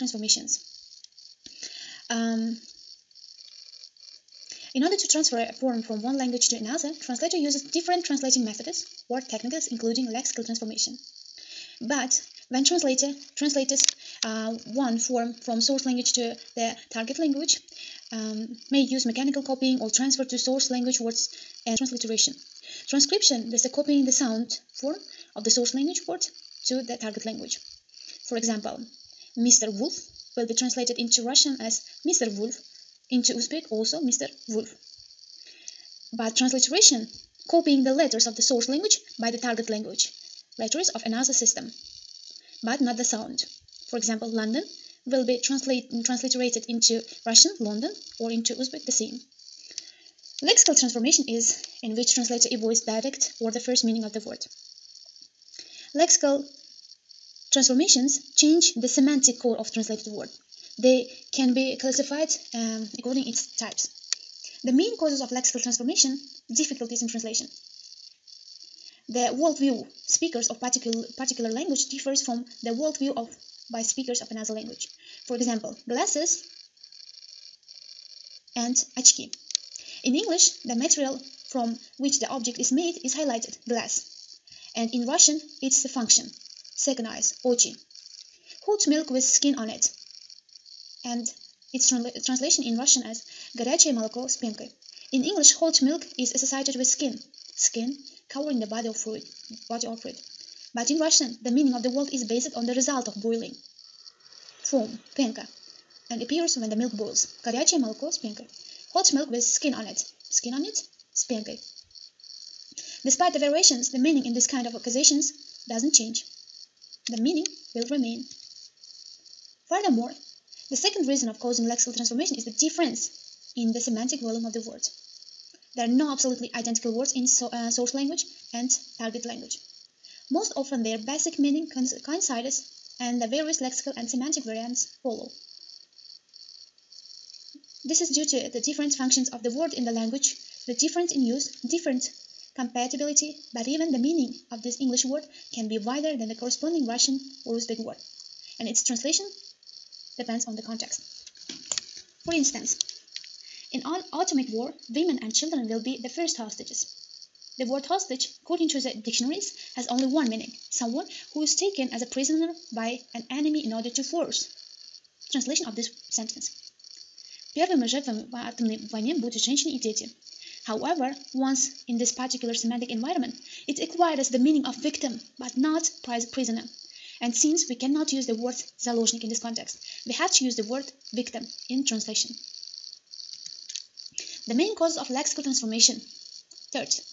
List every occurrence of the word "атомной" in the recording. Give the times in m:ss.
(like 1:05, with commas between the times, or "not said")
2:48.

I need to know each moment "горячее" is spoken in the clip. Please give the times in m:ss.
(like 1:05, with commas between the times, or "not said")
1:33, 1:47.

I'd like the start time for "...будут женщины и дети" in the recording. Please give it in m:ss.
2:49.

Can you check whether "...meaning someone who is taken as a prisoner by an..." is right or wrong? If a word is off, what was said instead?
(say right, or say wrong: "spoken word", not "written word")
right.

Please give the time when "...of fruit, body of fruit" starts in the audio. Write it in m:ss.
1:38.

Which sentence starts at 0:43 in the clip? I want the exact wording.
For example, London will be translate, transliterated into Russian London or into Uzbek the same.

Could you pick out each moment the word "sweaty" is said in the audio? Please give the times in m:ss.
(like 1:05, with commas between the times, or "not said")
not said.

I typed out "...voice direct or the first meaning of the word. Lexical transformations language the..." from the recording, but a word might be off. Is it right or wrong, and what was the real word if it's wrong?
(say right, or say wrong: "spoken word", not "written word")
wrong: "change", not "language".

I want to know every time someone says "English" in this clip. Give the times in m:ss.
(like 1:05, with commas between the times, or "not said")
1:20, 1:35, 2:24.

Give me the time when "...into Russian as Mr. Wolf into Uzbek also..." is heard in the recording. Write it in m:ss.
0:30.